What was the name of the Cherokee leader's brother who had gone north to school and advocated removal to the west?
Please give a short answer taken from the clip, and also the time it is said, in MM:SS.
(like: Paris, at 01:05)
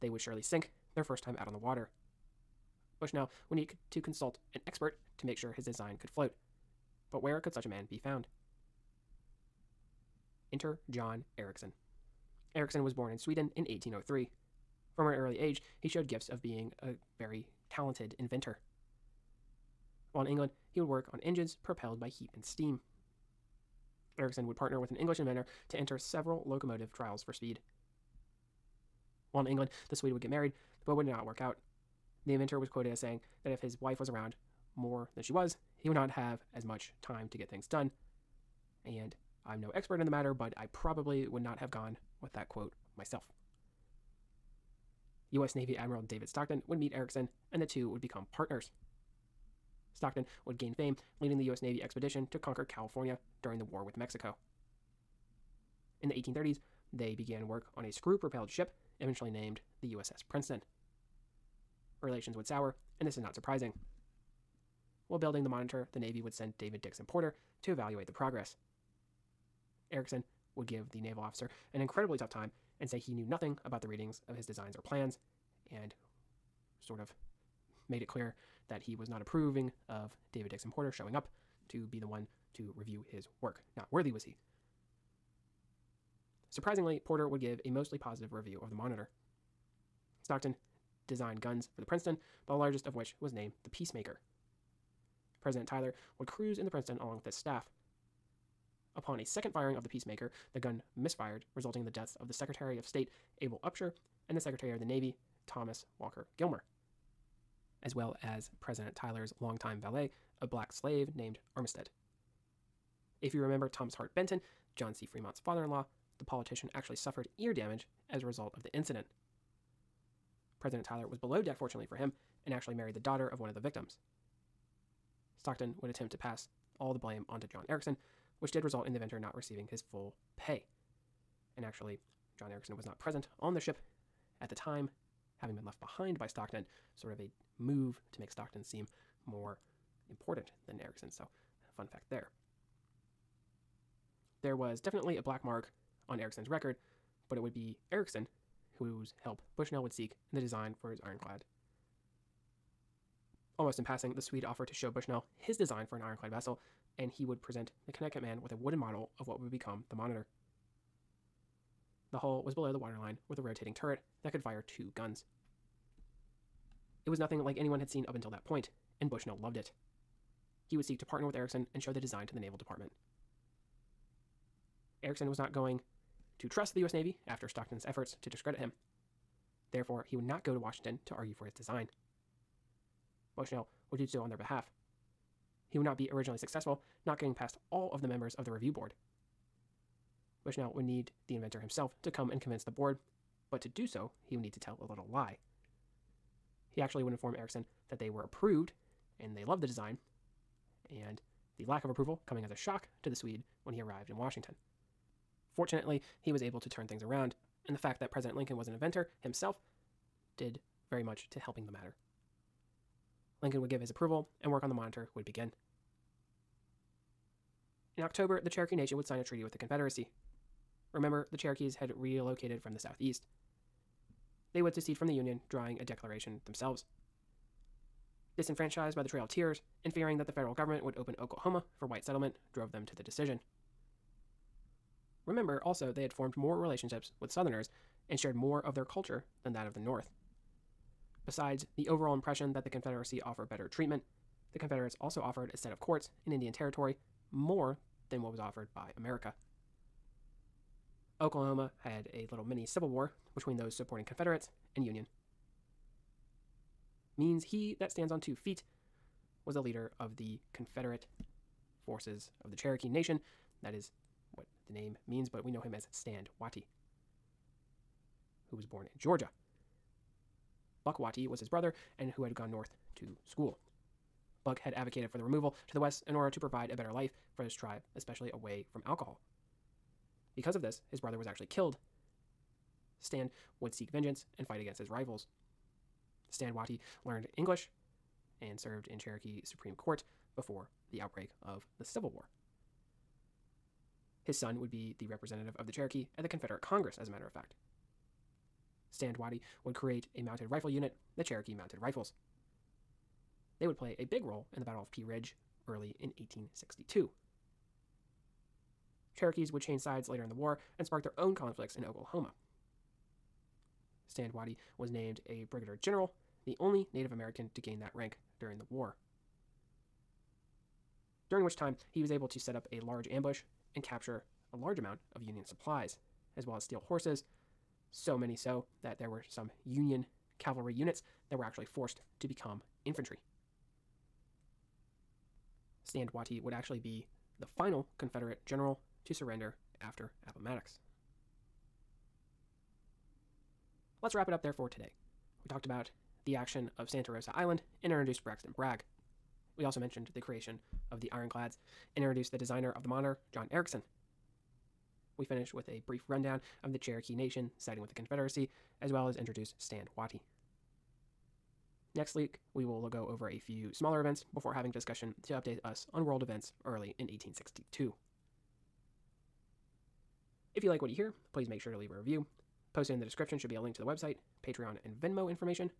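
Buck Watie, at 04:30.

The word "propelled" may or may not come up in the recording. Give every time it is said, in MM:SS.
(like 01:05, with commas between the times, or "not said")
00:21, 00:58.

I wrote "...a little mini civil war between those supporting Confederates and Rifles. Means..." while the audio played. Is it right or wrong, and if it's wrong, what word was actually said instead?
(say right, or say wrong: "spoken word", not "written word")
wrong: "Union", not "Rifles".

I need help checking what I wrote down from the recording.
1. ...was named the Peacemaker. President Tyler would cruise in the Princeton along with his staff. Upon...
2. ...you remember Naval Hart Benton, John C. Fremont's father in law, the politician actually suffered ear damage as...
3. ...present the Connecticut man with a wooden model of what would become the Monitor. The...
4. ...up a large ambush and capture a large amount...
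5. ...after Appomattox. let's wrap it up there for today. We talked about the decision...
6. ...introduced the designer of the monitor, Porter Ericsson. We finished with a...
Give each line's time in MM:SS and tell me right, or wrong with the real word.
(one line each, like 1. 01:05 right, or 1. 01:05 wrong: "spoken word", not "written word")
1. 01:33 right
2. 01:53 wrong: "Thomas", not "Naval"
3. 02:37 right
4. 05:22 right
5. 05:39 wrong: "action", not "decision"
6. 05:52 wrong: "John", not "Porter".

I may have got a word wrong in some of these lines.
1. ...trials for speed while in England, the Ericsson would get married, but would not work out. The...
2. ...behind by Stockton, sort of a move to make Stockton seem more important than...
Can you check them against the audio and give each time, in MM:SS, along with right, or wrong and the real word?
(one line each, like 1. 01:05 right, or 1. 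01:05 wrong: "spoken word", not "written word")
1. 00:26 wrong: "Swede", not "Ericsson"
2. 02:15 right.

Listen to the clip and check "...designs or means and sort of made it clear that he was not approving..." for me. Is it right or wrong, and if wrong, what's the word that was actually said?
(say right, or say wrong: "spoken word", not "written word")
wrong: "plans", not "means".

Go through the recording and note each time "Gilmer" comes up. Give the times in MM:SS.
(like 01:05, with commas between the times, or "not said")
01:46.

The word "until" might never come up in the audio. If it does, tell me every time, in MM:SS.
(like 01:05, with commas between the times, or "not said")
02:48.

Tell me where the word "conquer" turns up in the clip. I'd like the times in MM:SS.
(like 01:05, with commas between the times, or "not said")
00:52.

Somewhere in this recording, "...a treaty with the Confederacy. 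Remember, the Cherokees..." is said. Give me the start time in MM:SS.
03:39.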